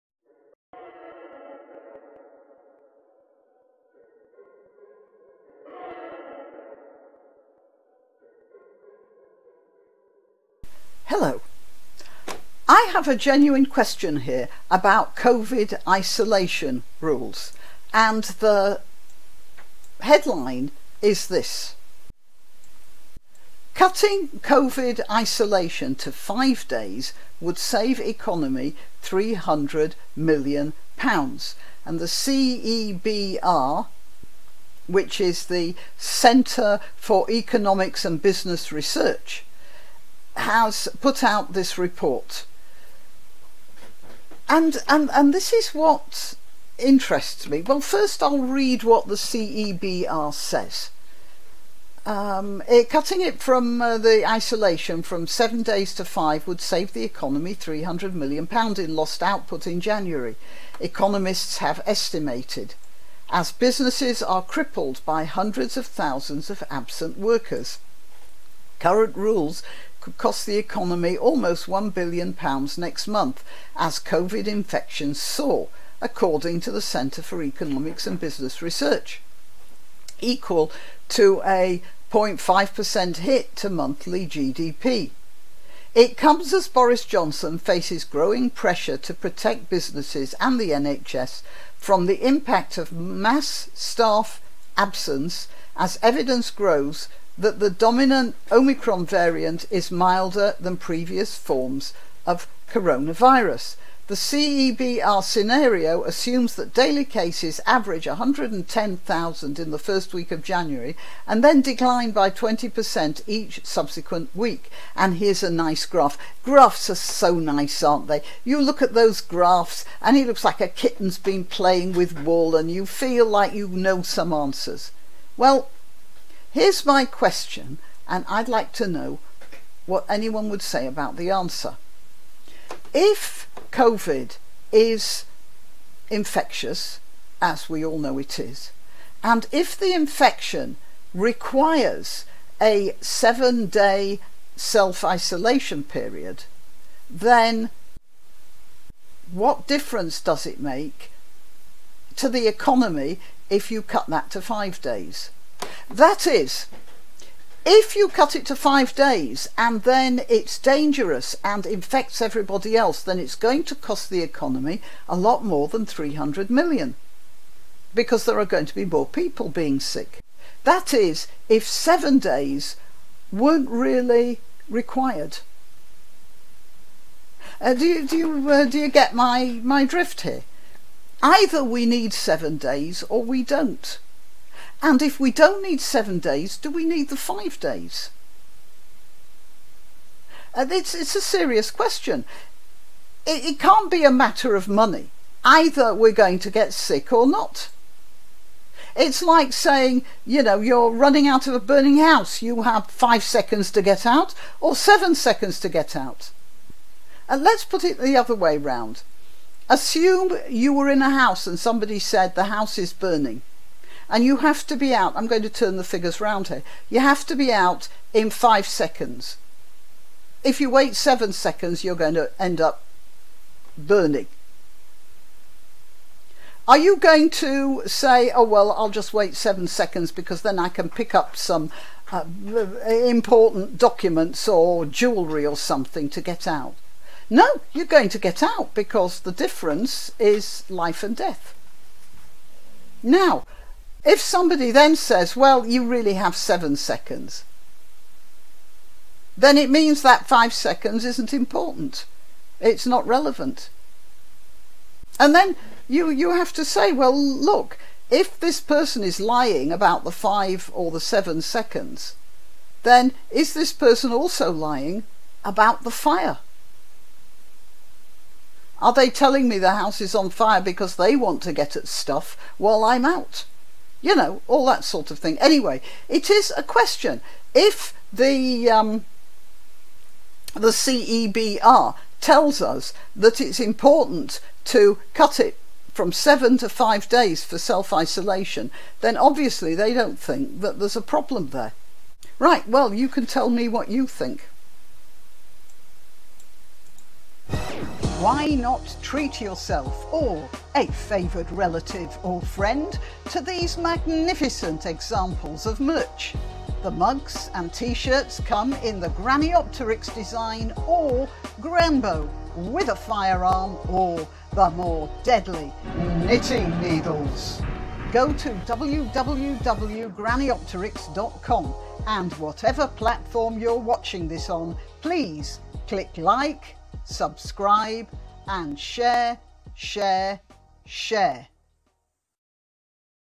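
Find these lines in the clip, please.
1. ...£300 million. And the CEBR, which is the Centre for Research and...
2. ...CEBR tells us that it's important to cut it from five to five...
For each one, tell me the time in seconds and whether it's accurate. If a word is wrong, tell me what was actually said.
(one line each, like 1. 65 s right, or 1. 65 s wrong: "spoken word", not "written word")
1. 29 s wrong: "Economics", not "Research"
2. 280 s wrong: "seven", not "five".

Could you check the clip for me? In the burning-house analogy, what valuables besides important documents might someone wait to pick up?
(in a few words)
Jewellery.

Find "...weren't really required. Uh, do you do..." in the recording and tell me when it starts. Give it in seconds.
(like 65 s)
173 s.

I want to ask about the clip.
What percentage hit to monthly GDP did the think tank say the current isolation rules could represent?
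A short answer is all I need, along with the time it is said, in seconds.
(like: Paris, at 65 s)
0.5%, at 82 s.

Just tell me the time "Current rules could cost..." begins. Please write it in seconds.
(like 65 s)
68 s.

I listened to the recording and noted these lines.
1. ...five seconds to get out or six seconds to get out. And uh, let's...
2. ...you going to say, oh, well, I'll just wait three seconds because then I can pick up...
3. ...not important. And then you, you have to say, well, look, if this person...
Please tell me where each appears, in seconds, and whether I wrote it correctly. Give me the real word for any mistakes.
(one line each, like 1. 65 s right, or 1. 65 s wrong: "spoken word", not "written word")
1. 202 s wrong: "seven", not "six"
2. 226 s wrong: "seven", not "three"
3. 252 s wrong: "relevant", not "important".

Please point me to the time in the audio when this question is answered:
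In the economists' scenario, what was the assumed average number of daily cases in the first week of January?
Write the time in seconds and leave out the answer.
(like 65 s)
108 s.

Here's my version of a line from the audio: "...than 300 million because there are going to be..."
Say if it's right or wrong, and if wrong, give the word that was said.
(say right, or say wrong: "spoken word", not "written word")
right.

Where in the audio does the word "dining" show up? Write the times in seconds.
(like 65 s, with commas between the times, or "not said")
not said.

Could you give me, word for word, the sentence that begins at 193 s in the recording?
It, it can't be a matter of money.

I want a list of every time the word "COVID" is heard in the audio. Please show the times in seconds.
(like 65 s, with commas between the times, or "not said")
15 s, 24 s, 73 s, 133 s.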